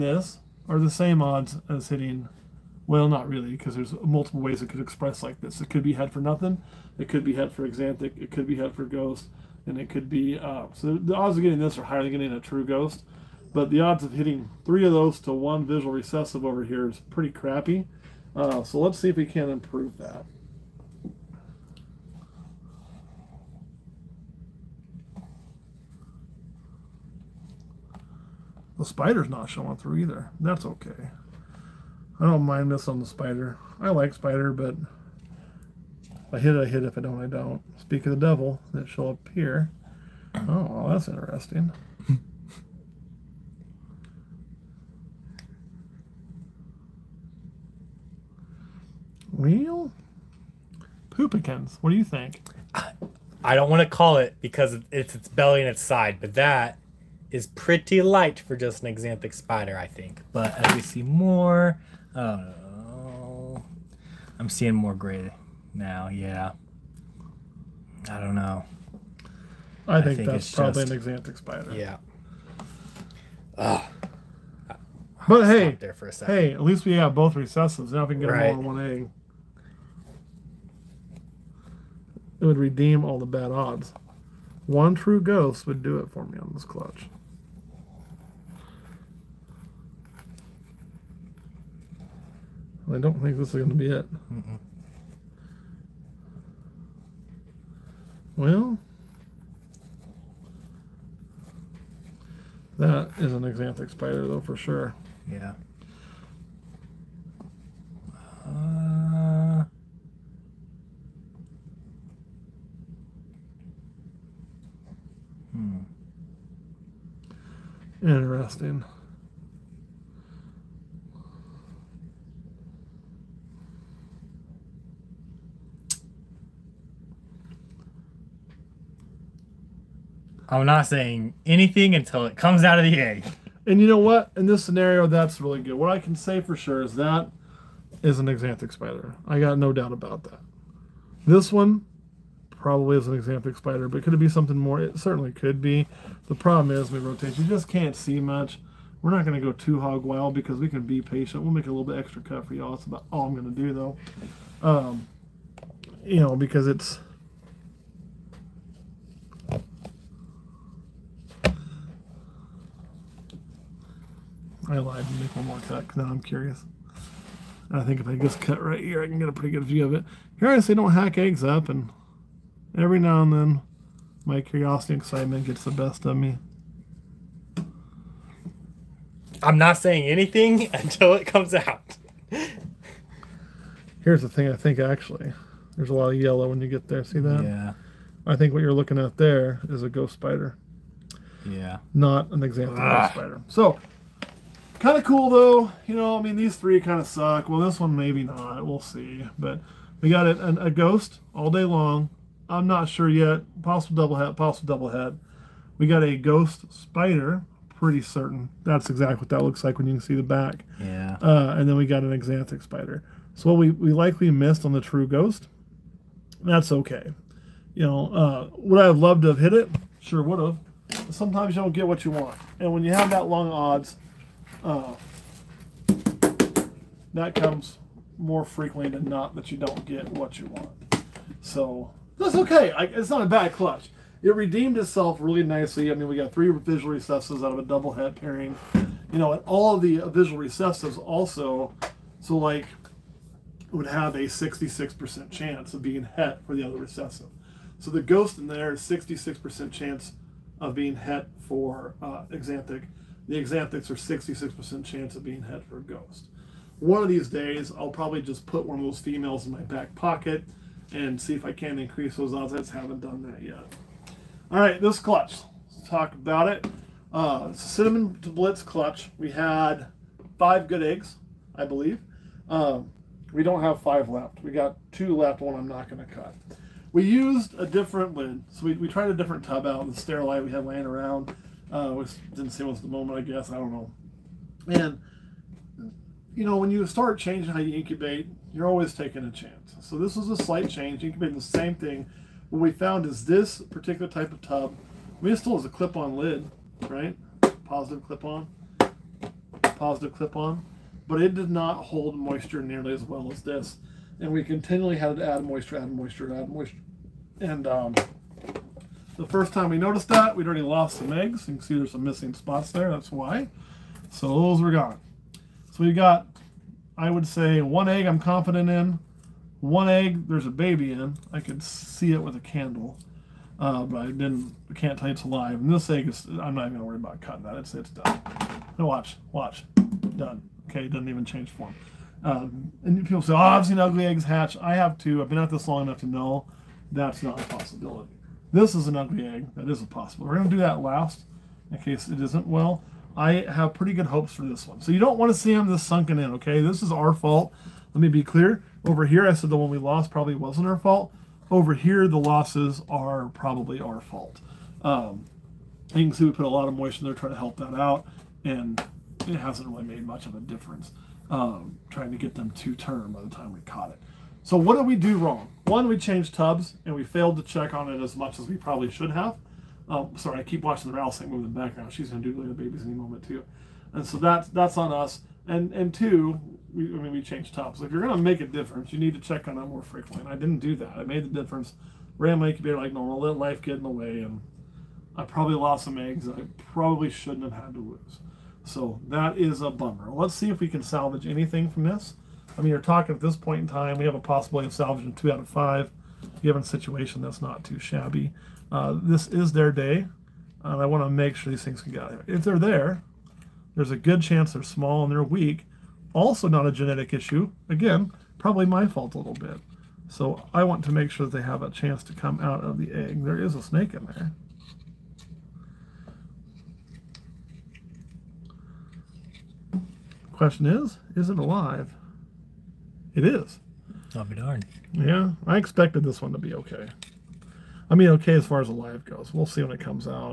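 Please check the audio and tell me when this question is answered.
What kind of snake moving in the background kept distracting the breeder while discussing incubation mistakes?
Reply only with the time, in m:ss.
6:10.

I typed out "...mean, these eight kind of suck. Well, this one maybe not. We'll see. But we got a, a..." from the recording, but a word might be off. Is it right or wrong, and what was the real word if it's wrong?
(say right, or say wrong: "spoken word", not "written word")
wrong: "three", not "eight".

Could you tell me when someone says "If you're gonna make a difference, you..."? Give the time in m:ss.
6:17.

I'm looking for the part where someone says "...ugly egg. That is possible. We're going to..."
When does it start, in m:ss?
5:38.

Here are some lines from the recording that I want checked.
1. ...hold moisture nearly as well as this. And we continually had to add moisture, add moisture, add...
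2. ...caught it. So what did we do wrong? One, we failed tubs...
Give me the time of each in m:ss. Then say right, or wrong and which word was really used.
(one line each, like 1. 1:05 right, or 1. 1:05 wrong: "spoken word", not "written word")
1. 5:01 right
2. 6:03 wrong: "changed", not "failed".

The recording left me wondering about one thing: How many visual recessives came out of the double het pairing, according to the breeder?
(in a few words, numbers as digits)
3.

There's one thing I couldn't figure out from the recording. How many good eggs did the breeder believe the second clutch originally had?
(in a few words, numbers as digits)
5.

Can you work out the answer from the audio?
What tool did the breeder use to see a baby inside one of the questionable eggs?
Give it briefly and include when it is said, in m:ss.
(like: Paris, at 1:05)
A candle, at 5:22.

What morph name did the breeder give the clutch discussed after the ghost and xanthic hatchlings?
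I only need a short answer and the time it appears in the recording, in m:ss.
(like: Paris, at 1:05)
Cinnamon blitz, at 4:27.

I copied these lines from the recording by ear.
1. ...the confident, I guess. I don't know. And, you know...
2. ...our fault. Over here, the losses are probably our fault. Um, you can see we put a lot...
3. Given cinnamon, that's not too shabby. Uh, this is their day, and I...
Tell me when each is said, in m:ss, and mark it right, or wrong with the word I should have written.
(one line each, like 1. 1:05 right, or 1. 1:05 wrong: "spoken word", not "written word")
1. 4:42 wrong: "moment", not "confident"
2. 5:50 right
3. 6:36 wrong: "situation", not "cinnamon".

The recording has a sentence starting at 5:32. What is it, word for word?
Um, and people say, oh, I've seen ugly eggs hatch.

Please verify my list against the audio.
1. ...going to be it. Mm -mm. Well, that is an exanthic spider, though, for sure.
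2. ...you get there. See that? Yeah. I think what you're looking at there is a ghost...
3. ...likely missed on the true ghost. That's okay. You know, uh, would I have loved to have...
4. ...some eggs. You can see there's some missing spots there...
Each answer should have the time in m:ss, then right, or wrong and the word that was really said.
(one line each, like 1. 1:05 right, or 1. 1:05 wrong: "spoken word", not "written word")
1. 1:33 wrong: "xanthic", not "exanthic"
2. 3:06 right
3. 3:33 right
4. 5:10 right.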